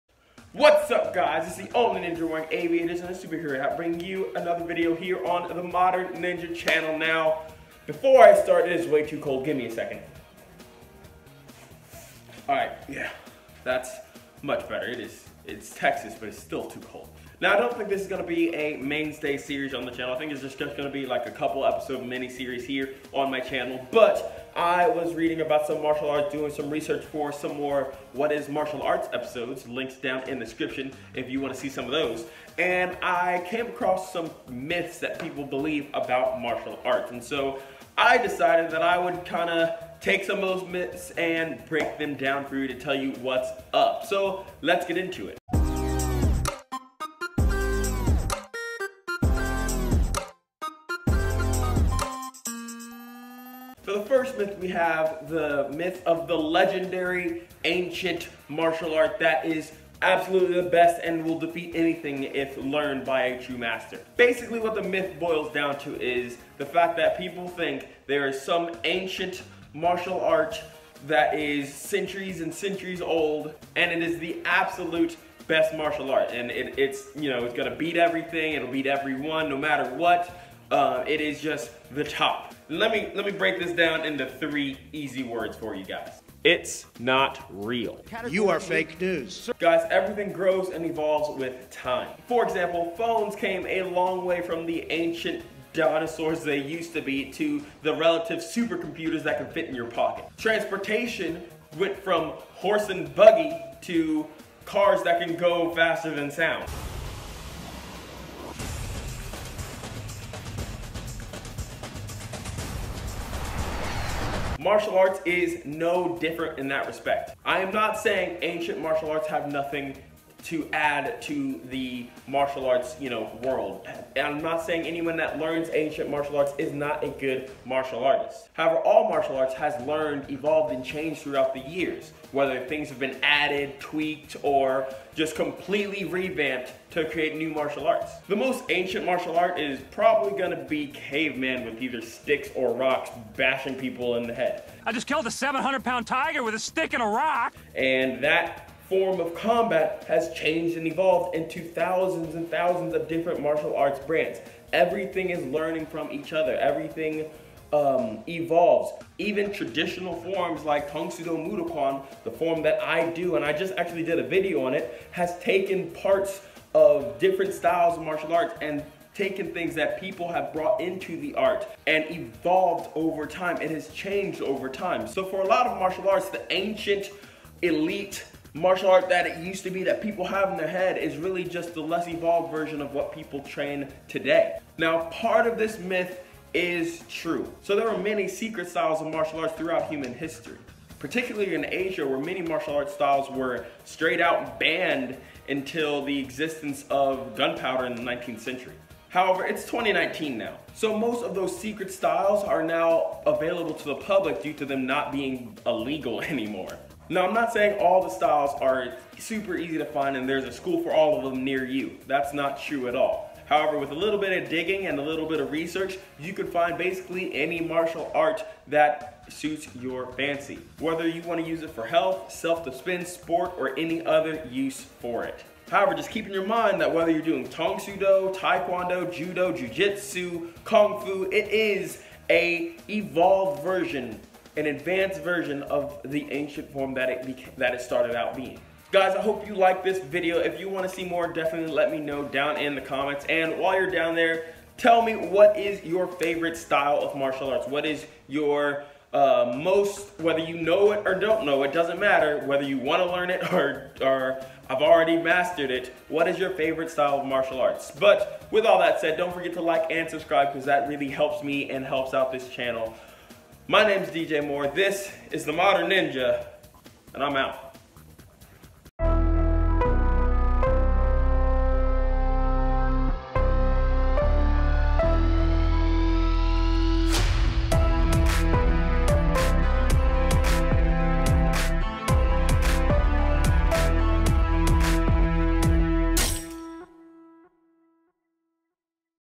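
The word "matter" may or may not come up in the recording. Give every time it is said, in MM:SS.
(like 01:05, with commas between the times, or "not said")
01:19, 04:11.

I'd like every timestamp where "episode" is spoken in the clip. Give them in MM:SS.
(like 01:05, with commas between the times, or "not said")
00:21, 00:29.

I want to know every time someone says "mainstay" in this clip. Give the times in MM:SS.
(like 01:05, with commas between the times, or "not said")
00:18.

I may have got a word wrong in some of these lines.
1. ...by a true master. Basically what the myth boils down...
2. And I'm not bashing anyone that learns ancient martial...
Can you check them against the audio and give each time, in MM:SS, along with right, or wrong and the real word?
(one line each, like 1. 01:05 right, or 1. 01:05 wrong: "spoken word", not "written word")
1. 01:03 right
2. 02:04 wrong: "saying", not "bashing".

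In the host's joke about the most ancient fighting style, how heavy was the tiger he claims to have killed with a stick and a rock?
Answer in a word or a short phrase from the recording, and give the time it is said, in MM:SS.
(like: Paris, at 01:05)
700 pounds, at 02:25.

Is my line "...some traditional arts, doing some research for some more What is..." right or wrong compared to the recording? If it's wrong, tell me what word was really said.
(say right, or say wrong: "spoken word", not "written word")
wrong: "martial", not "traditional".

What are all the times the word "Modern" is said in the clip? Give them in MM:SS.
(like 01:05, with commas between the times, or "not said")
00:05, 04:25.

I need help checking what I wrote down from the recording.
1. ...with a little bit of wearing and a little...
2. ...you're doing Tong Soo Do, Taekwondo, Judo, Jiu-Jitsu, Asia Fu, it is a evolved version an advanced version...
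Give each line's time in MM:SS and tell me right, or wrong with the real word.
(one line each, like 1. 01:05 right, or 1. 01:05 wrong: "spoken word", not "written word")
1. 03:33 wrong: "digging", not "wearing"
2. 03:47 wrong: "Kung", not "Asia".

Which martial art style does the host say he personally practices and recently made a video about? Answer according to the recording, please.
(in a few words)
Tang Soo Do Moo Duk Kwan.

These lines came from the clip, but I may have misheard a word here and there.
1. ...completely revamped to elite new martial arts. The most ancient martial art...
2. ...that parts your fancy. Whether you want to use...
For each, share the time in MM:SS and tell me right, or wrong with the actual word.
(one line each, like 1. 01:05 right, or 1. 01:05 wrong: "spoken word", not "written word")
1. 02:15 wrong: "create", not "elite"
2. 03:38 wrong: "suits", not "parts".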